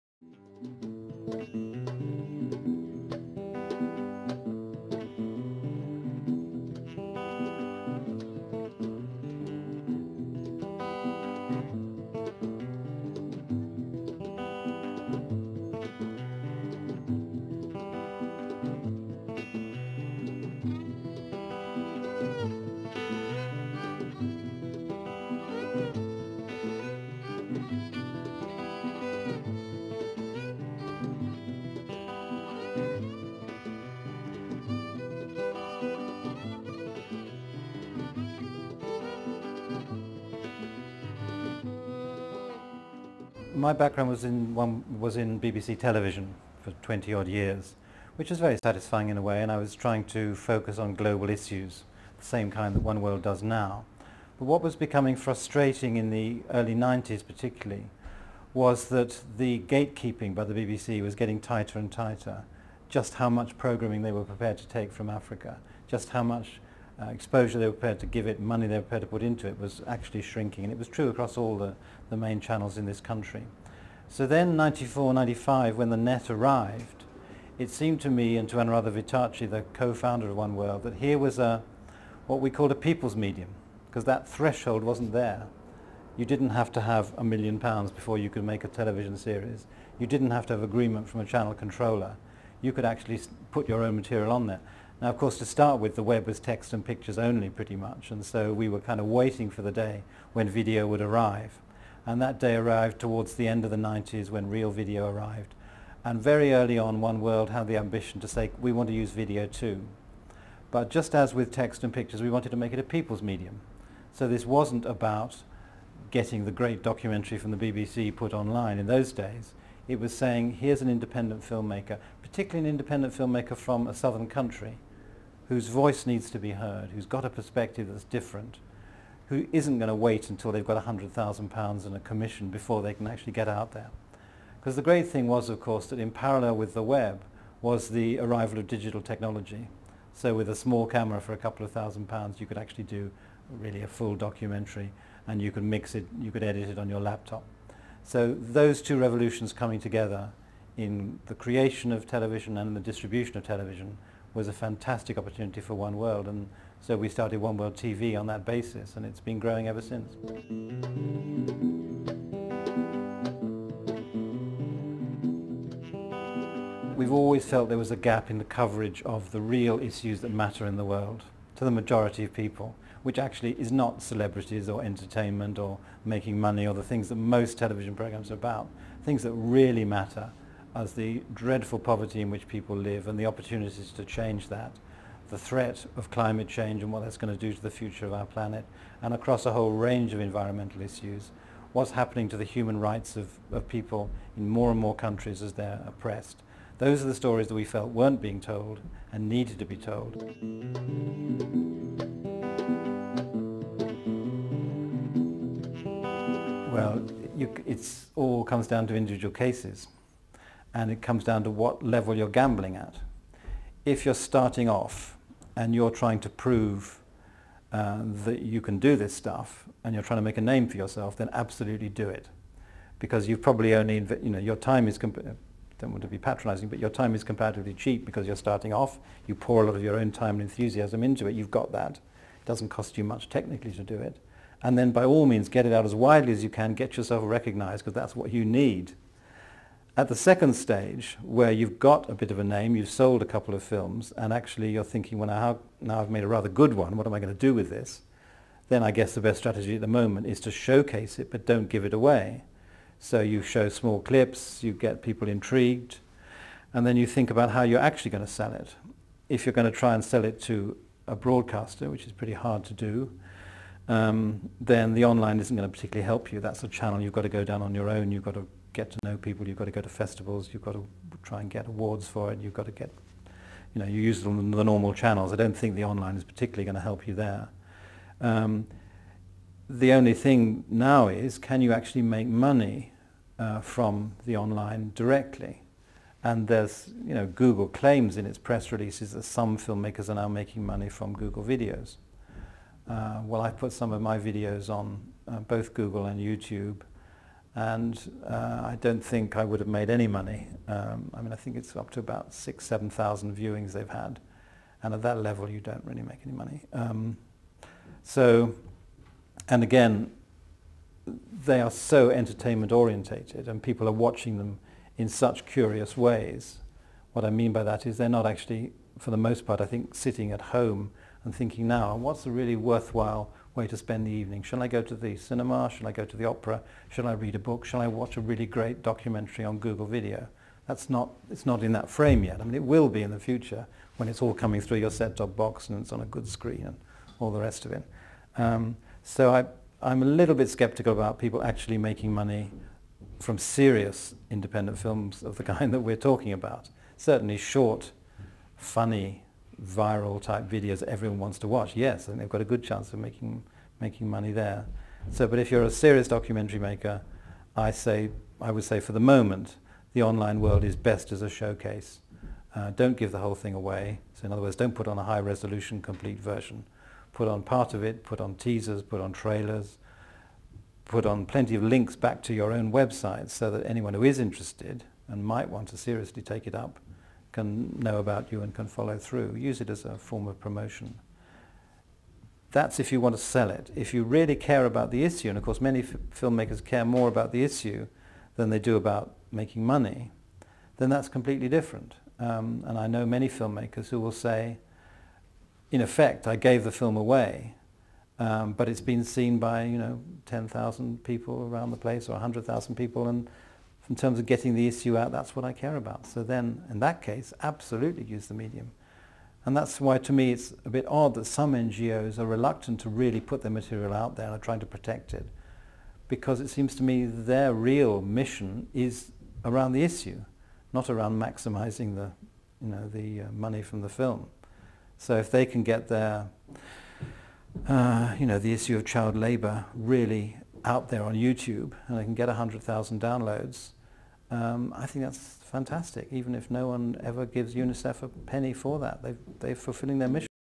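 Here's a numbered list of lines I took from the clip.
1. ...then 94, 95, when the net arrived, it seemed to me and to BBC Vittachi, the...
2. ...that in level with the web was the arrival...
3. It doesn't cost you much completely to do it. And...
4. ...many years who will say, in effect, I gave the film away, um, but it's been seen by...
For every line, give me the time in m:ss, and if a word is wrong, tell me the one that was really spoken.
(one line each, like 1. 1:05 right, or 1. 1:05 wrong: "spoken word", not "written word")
1. 1:14 wrong: "Anuradha", not "BBC"
2. 2:15 wrong: "parallel", not "level"
3. 3:51 wrong: "technically", not "completely"
4. 6:33 wrong: "filmmakers", not "years".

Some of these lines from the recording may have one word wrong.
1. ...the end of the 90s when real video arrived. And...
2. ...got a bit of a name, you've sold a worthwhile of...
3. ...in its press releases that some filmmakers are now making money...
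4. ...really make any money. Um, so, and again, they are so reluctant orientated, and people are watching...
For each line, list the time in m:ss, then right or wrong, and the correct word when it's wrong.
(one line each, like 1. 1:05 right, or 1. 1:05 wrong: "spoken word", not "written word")
1. 1:43 right
2. 4:01 wrong: "couple", not "worthwhile"
3. 4:48 right
4. 5:05 wrong: "entertainment", not "reluctant".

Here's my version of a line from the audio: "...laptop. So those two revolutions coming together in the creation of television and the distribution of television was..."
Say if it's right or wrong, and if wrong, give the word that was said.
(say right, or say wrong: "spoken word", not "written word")
right.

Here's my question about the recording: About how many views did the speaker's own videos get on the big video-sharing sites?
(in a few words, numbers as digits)
6,000-7,000.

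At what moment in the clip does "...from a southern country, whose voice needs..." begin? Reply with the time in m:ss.
2:03.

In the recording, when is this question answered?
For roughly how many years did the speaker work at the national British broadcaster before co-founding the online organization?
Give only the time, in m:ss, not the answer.
0:46.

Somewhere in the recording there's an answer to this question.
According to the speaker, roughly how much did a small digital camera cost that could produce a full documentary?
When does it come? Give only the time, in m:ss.
2:21.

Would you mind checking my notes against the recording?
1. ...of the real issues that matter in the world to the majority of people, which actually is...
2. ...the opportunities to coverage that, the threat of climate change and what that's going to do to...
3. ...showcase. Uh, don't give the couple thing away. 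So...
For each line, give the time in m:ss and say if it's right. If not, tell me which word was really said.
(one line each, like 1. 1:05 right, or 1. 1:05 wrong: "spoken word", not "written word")
1. 2:49 right
2. 3:03 wrong: "change", not "coverage"
3. 6:01 wrong: "whole", not "couple".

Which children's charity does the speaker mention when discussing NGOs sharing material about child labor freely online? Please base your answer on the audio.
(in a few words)
UNICEF.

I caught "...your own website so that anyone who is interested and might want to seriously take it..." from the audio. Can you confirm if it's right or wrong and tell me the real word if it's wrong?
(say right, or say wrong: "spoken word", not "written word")
right.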